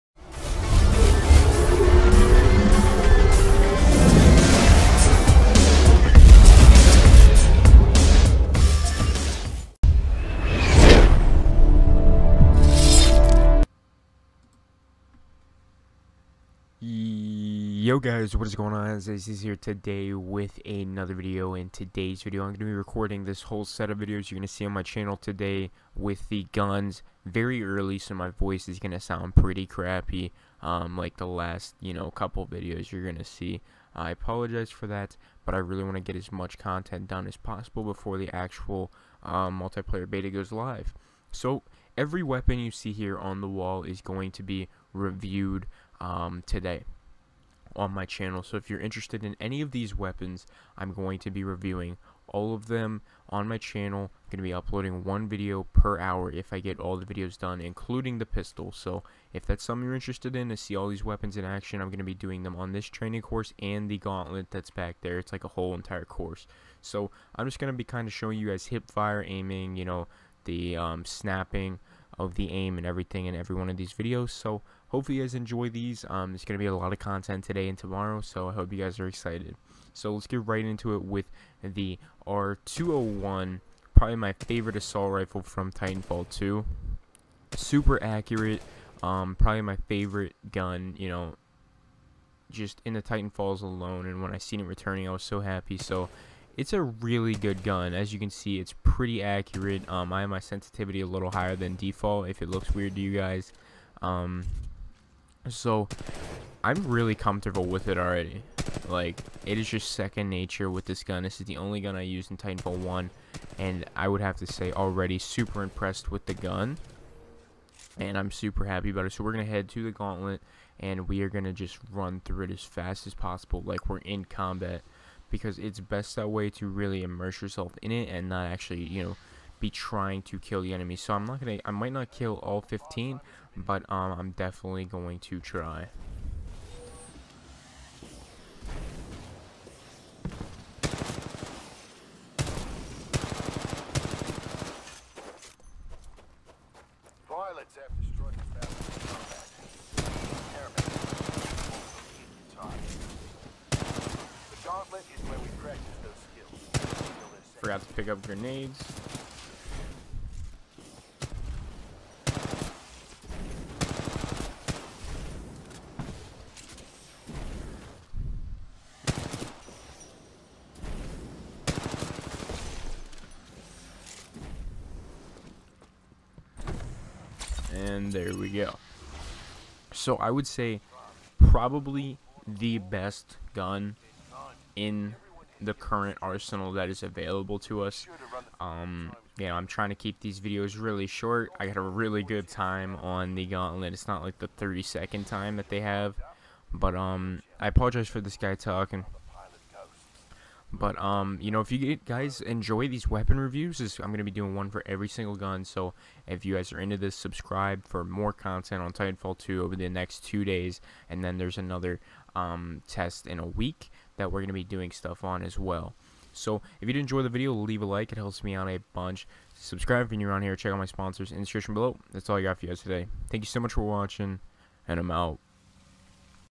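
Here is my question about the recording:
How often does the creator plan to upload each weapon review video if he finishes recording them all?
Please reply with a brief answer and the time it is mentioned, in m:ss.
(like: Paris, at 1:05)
One video per hour, at 0:55.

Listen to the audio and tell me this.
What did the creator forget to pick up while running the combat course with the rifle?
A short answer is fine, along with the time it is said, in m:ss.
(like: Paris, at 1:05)
Grenades, at 2:38.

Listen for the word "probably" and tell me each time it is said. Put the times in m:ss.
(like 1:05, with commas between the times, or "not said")
1:23, 1:29, 3:01.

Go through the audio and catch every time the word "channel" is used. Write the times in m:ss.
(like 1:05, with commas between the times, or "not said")
0:24, 0:48, 0:53.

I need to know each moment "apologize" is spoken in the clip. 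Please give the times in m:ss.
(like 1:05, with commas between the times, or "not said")
0:34, 3:17.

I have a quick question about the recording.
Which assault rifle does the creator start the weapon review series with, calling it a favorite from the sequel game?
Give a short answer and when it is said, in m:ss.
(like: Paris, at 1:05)
R201, at 1:22.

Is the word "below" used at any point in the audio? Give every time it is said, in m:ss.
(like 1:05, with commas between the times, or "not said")
3:41.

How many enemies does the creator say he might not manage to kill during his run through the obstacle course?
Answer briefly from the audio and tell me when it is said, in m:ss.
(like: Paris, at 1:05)
15, at 2:12.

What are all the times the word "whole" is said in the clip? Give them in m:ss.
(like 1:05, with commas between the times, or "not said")
0:23, 1:05.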